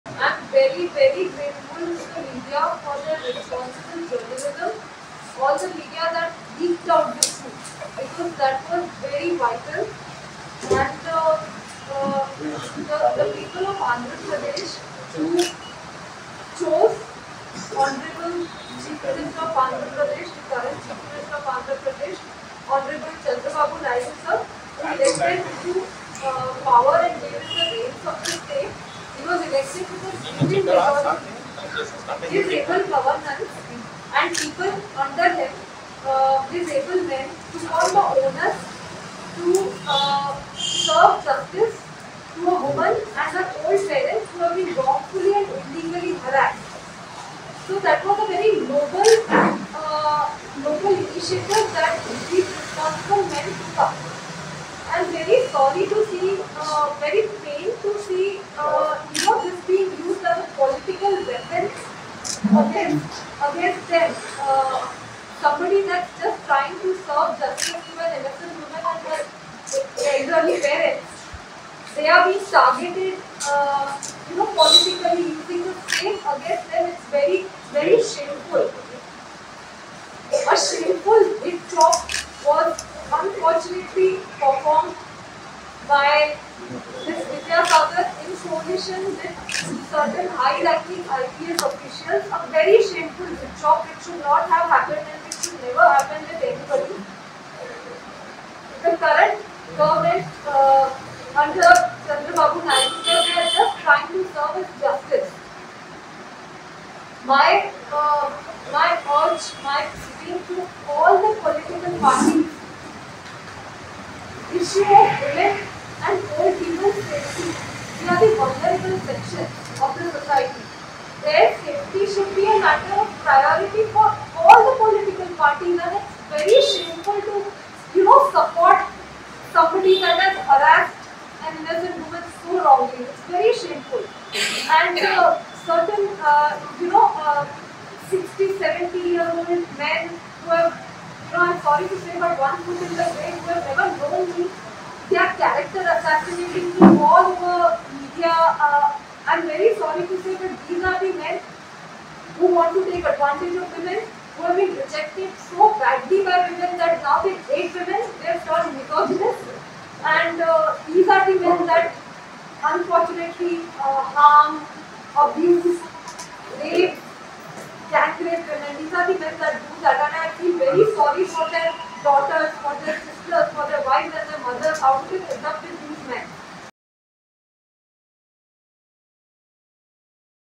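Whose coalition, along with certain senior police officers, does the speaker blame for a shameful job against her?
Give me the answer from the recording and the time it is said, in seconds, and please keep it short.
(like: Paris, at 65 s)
Vidya Sagar, at 87 s.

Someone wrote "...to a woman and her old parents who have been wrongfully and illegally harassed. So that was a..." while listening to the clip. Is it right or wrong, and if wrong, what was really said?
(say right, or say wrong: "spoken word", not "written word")
right.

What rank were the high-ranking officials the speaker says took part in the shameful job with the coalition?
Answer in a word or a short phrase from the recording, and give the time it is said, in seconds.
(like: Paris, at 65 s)
IPS, at 91 s.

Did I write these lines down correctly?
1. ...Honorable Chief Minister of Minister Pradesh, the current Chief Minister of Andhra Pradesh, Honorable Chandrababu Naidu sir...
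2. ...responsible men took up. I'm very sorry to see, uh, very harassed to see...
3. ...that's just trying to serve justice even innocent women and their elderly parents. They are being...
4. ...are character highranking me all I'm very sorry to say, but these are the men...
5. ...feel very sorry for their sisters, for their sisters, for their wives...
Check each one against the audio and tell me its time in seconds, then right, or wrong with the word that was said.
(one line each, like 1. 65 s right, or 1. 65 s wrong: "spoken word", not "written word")
1. 17 s wrong: "Andhra", not "Minister"
2. 52 s wrong: "pained", not "harassed"
3. 65 s right
4. 145 s wrong: "assassinating", not "highranking"
5. 170 s wrong: "daughters", not "sisters".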